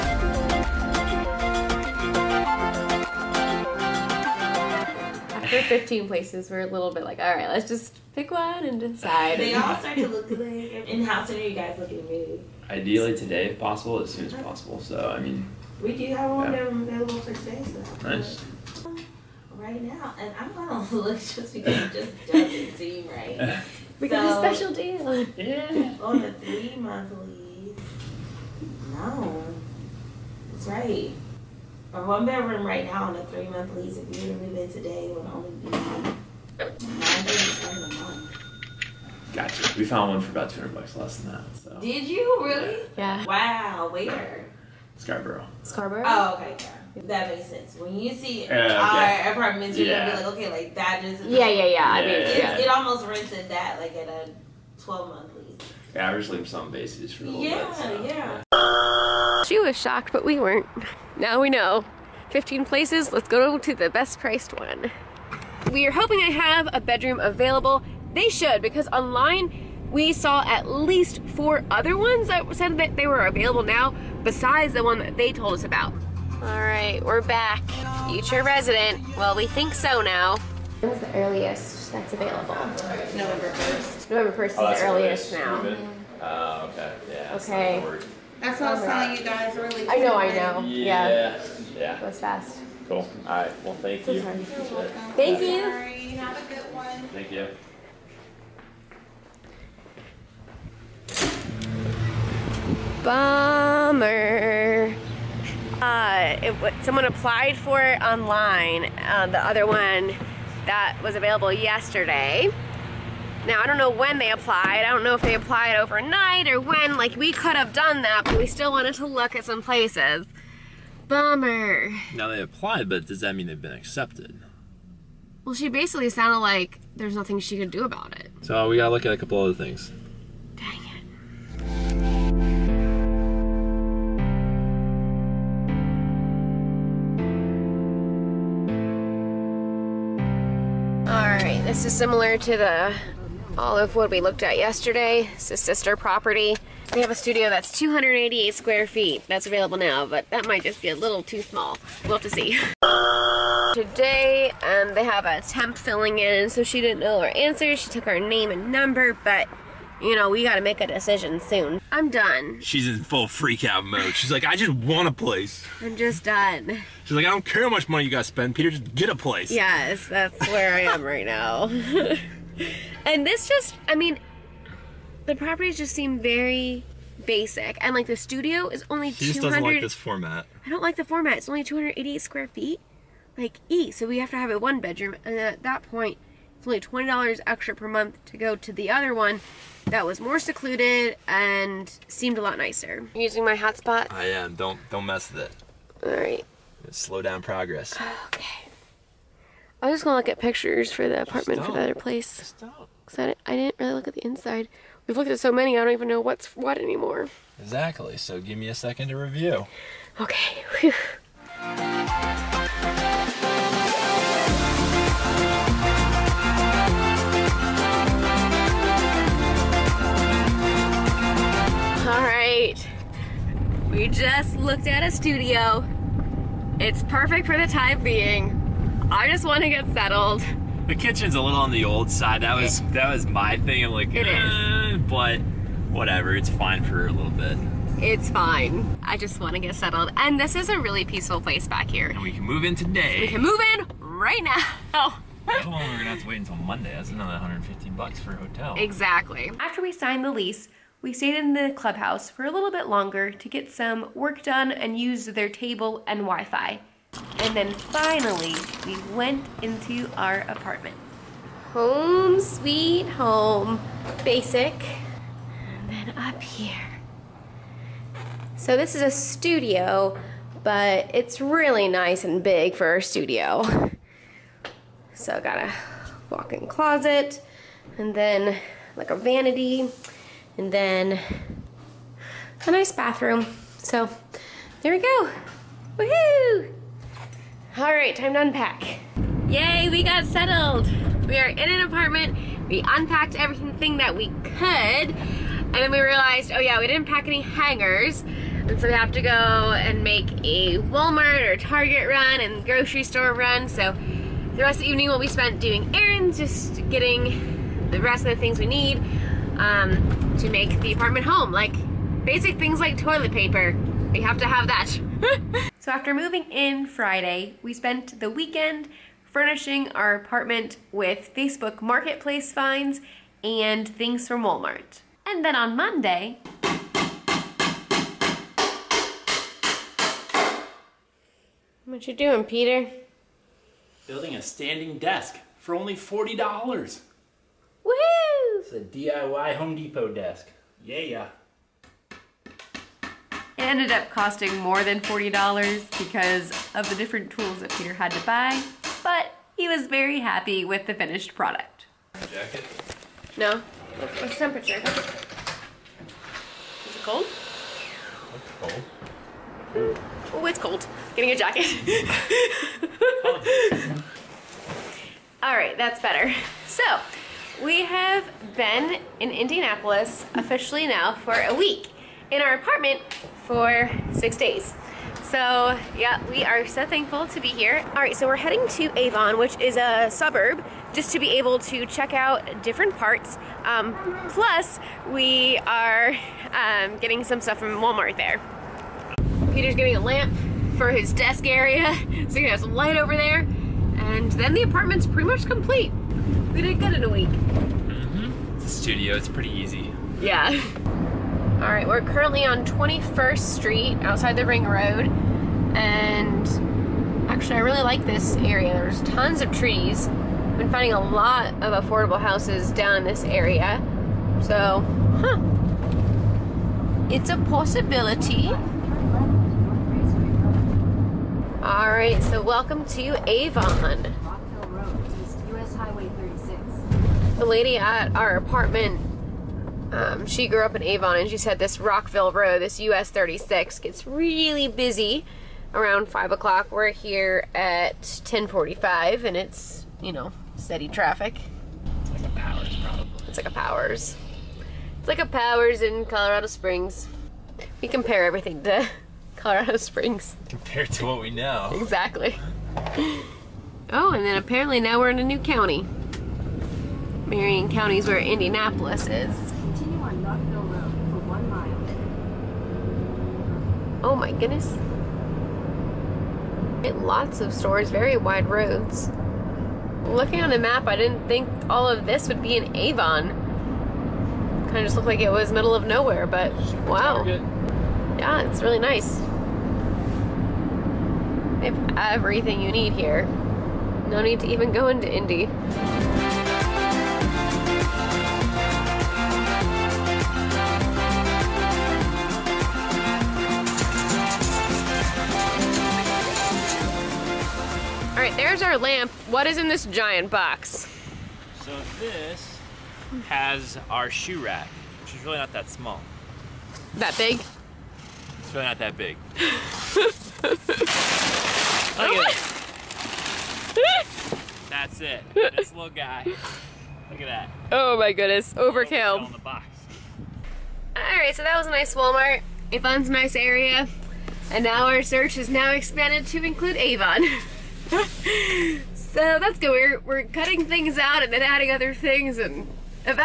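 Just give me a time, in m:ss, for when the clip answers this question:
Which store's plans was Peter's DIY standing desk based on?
5:39.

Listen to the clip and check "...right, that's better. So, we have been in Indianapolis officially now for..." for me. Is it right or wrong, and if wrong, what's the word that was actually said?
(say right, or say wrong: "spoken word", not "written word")
right.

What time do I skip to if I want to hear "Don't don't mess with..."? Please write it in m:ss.
3:14.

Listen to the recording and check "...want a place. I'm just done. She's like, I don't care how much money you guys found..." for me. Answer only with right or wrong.
wrong.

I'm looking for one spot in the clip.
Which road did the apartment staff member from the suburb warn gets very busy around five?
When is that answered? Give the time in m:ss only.
7:11.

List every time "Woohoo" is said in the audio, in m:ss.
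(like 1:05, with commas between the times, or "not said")
4:45, 5:36.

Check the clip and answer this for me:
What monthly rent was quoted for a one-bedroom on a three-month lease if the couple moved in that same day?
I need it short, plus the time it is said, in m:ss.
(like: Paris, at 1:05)
$937, at 0:35.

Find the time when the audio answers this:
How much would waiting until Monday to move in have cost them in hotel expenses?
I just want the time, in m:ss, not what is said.
4:07.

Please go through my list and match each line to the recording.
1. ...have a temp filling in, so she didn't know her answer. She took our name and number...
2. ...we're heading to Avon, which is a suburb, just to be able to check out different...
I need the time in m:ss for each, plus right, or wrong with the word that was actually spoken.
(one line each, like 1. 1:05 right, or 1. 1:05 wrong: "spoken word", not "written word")
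1. 2:35 right
2. 6:18 right.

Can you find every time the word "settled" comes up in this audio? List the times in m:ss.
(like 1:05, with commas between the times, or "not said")
3:49, 3:59, 4:50.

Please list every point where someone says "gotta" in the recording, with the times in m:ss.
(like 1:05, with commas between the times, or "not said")
2:08, 2:40.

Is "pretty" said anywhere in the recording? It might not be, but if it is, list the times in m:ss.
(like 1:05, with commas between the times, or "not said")
6:35, 6:39.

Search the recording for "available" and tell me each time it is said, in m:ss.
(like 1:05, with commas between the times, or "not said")
0:16, 1:07, 1:13, 1:22, 1:51, 2:29.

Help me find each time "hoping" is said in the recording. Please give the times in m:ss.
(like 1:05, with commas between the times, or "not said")
1:05.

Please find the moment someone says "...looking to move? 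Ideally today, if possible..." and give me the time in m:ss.
0:11.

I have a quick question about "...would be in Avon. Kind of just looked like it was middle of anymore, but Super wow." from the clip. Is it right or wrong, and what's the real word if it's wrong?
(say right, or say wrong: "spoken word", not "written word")
wrong: "nowhere", not "anymore".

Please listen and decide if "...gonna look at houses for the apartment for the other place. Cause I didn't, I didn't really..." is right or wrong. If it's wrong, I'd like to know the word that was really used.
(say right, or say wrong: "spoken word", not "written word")
wrong: "pictures", not "houses".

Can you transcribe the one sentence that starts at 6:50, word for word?
I've been finding a lot of affordable houses down in this area, so, huh.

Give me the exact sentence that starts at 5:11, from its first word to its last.
Like basic things like toilet paper.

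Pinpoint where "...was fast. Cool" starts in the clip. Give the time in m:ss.
1:32.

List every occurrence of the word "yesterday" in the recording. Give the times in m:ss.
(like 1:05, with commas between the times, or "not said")
1:51, 2:24.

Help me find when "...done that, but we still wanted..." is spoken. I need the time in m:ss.
1:57.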